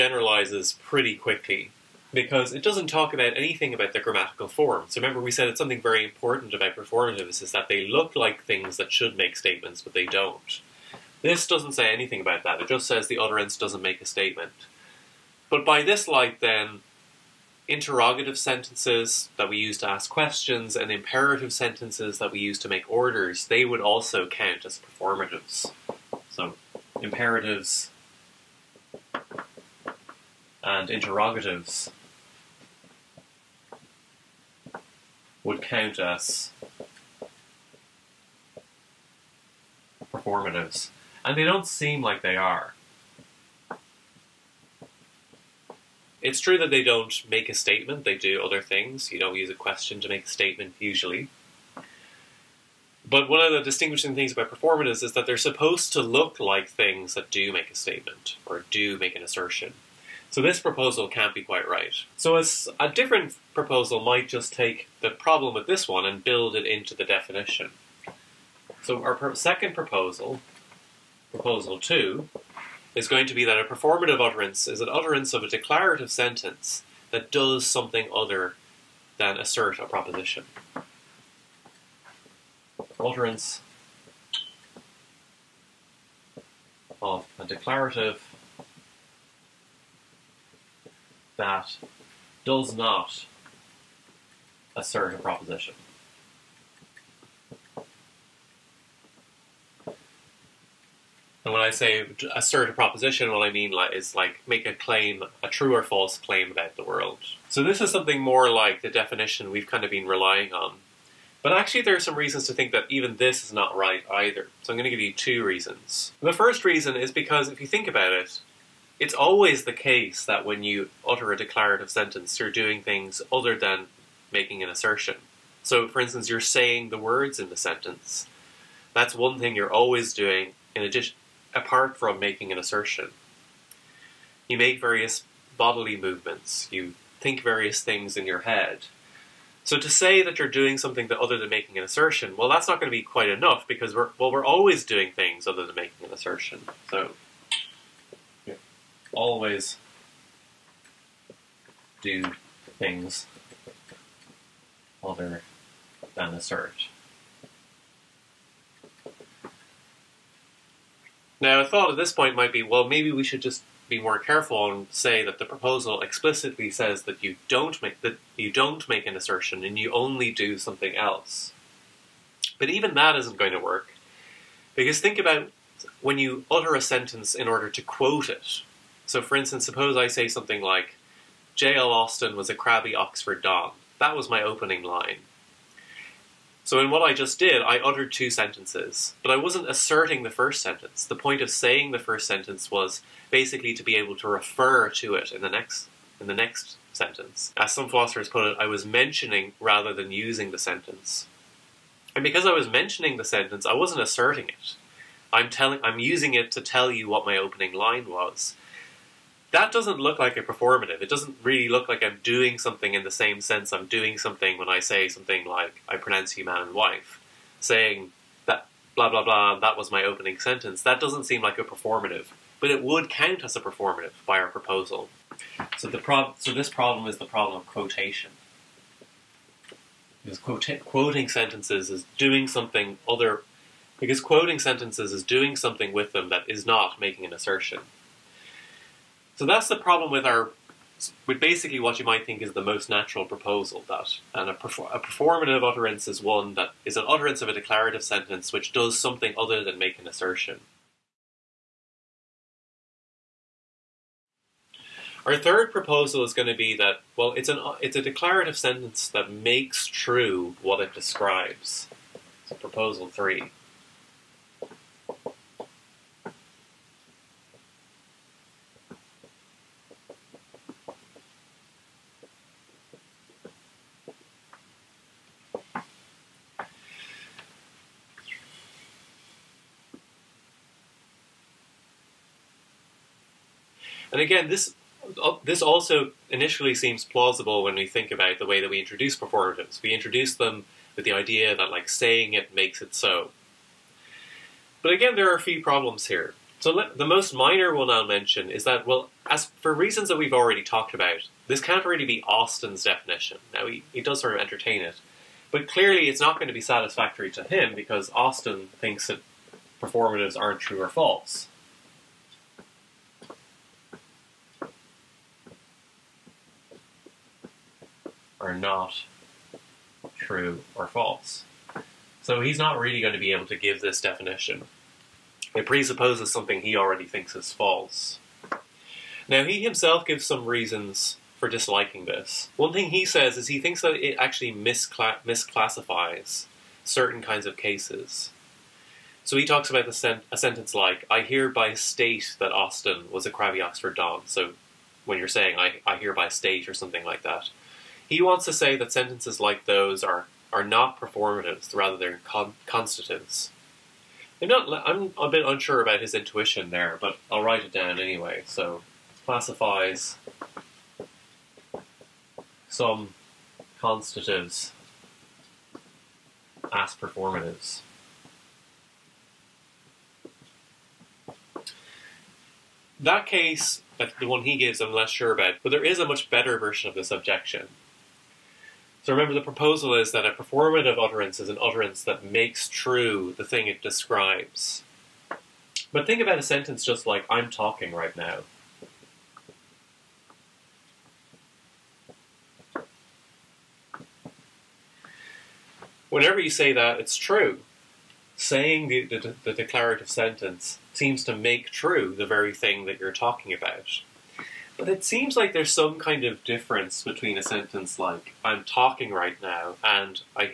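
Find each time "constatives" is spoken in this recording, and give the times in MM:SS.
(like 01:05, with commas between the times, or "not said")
05:52, 06:03.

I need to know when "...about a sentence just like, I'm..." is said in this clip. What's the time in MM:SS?
06:26.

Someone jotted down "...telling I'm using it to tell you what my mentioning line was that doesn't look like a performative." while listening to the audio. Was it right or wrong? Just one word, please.
wrong.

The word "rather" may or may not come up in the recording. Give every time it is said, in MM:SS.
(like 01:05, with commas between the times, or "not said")
03:19, 05:51.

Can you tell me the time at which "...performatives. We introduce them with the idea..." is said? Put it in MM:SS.
04:49.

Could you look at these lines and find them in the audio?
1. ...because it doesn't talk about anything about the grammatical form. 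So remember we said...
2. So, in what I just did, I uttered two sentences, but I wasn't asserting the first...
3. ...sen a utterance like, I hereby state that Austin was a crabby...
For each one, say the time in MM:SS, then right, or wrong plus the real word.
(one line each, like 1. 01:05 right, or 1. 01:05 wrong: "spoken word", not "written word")
1. 00:02 right
2. 03:06 right
3. 05:39 wrong: "sentence", not "utterance".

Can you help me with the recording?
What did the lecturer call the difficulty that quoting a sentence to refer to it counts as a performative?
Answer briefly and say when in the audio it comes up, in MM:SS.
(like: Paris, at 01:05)
the problem of quotation, at 03:47.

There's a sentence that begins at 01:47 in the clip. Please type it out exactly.
So this is something more like the definition we've kind of been relying on.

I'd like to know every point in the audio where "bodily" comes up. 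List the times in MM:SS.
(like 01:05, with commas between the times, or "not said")
02:15.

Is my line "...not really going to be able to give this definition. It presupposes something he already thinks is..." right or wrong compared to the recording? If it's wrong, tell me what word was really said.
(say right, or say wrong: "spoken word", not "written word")
right.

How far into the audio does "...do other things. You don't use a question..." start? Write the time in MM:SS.
00:48.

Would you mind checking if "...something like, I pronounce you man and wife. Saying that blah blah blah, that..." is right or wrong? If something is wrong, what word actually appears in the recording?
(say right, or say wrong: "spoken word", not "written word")
right.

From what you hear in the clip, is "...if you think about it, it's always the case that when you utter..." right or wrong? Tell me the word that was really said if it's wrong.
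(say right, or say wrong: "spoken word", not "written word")
right.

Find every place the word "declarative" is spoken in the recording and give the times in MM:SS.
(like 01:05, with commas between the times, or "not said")
01:15, 01:27, 02:01, 04:07, 04:18, 06:39.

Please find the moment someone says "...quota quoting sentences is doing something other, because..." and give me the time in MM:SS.
03:50.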